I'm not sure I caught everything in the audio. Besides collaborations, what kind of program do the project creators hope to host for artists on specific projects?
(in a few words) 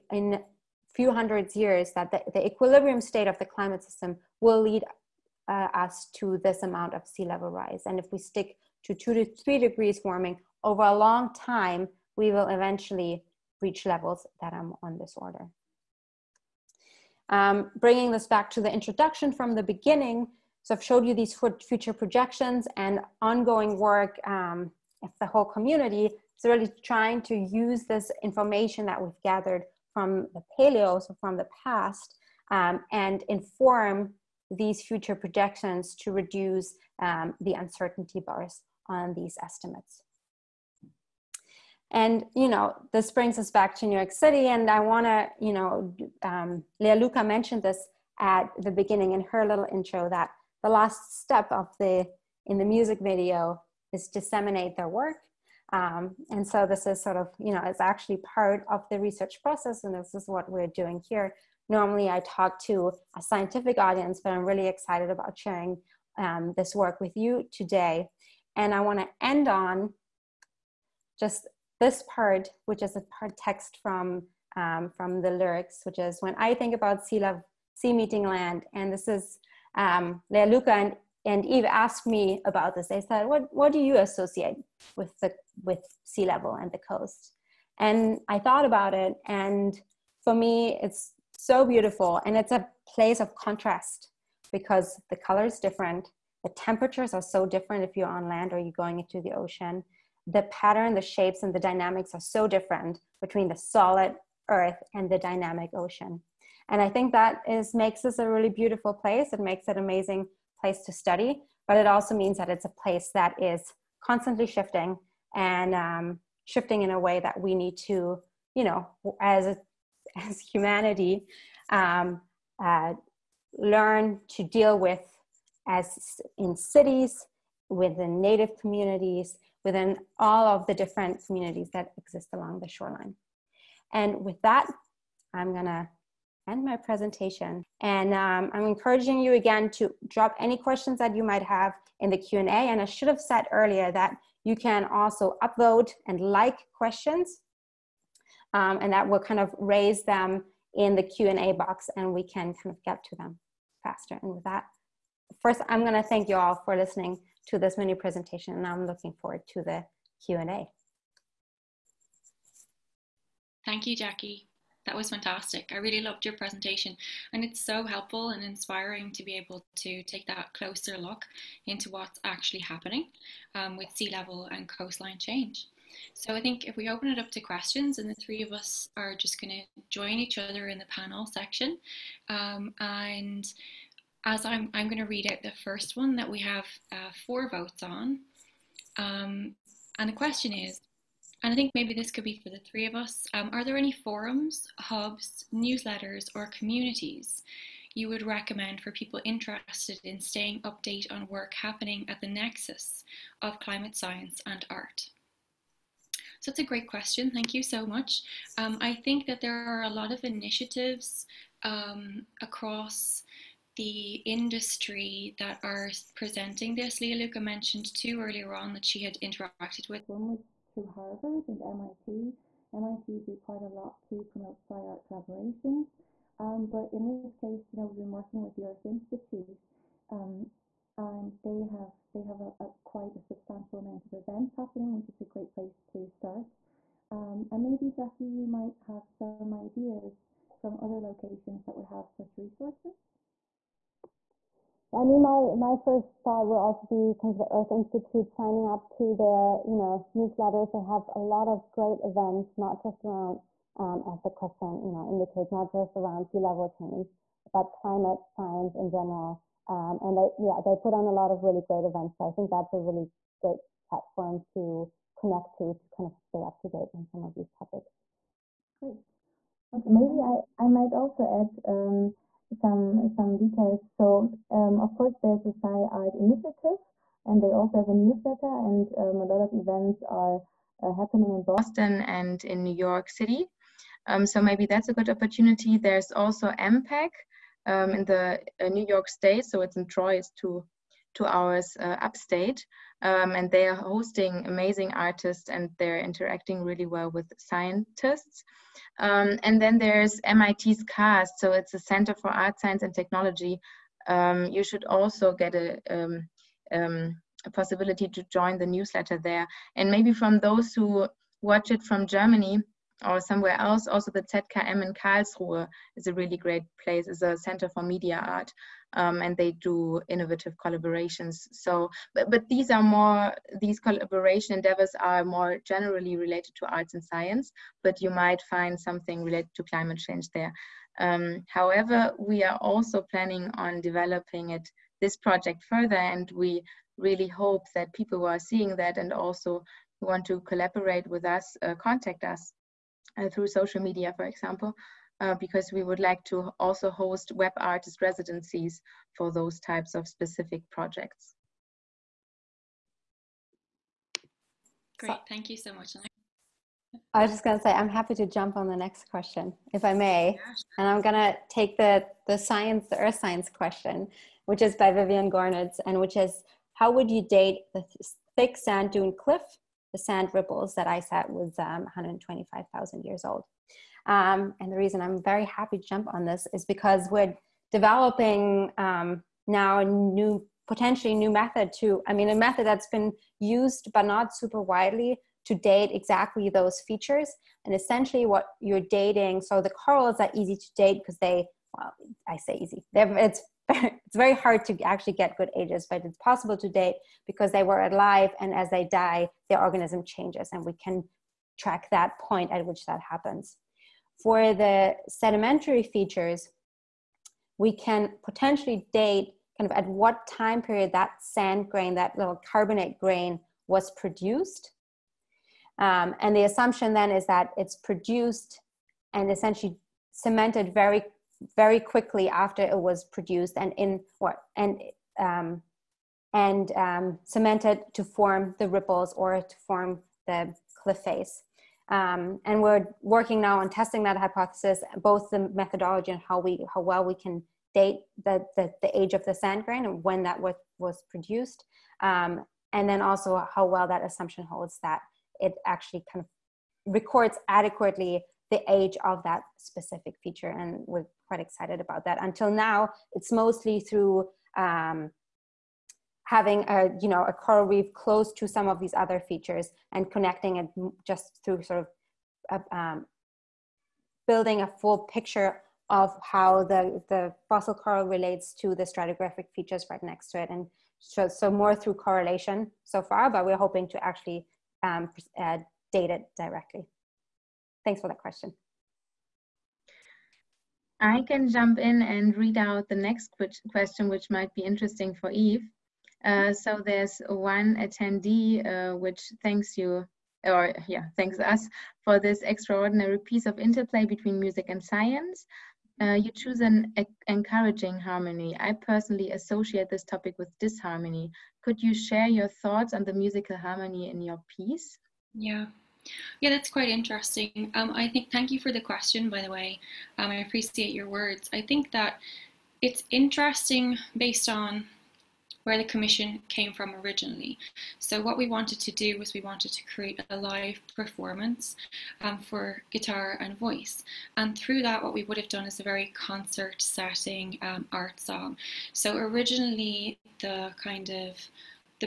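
artist residencies.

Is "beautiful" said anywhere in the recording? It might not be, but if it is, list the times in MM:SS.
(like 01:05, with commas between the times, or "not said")
01:31, 01:48.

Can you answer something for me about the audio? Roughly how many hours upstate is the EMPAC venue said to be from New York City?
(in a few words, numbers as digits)
2 hours.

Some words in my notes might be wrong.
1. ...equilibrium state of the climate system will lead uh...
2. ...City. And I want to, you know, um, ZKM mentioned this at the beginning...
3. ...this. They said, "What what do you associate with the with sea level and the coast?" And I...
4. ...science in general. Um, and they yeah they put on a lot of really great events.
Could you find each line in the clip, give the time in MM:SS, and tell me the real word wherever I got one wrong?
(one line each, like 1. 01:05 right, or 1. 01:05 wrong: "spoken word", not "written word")
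1. 00:02 right
2. 00:44 wrong: "Luka", not "ZKM"
3. 01:22 right
4. 04:18 right.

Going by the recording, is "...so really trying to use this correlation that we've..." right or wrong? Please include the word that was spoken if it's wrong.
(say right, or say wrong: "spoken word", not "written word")
wrong: "information", not "correlation".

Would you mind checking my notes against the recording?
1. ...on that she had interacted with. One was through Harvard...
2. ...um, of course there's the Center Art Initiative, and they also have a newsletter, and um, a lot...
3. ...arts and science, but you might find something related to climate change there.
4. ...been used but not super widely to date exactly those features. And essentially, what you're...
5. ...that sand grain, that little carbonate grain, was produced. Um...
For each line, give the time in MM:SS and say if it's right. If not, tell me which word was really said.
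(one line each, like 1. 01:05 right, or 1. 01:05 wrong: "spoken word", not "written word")
1. 03:38 right
2. 04:34 wrong: "Sci", not "Center"
3. 05:26 right
4. 06:22 right
5. 06:50 right.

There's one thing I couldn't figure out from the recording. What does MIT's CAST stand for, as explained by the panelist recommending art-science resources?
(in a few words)
Center for Art, Science and Technology.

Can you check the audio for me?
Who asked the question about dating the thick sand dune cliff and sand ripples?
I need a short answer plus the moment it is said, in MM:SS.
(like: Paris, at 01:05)
Vivien Gornitz, at 06:04.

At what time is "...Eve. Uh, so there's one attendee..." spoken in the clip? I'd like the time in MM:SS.
08:05.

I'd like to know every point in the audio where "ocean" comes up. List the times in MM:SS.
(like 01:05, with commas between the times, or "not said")
01:39, 01:45.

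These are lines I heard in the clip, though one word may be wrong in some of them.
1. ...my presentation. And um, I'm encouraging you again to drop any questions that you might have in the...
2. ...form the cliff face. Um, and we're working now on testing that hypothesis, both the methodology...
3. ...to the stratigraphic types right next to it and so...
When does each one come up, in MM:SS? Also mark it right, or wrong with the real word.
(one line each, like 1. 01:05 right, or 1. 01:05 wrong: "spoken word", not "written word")
1. 02:16 right
2. 07:09 right
3. 07:48 wrong: "features", not "types".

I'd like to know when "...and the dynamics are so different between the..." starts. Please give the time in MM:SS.
01:41.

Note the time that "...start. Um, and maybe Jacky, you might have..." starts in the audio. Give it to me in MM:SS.
03:56.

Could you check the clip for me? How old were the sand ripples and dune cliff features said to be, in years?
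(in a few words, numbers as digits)
125,000.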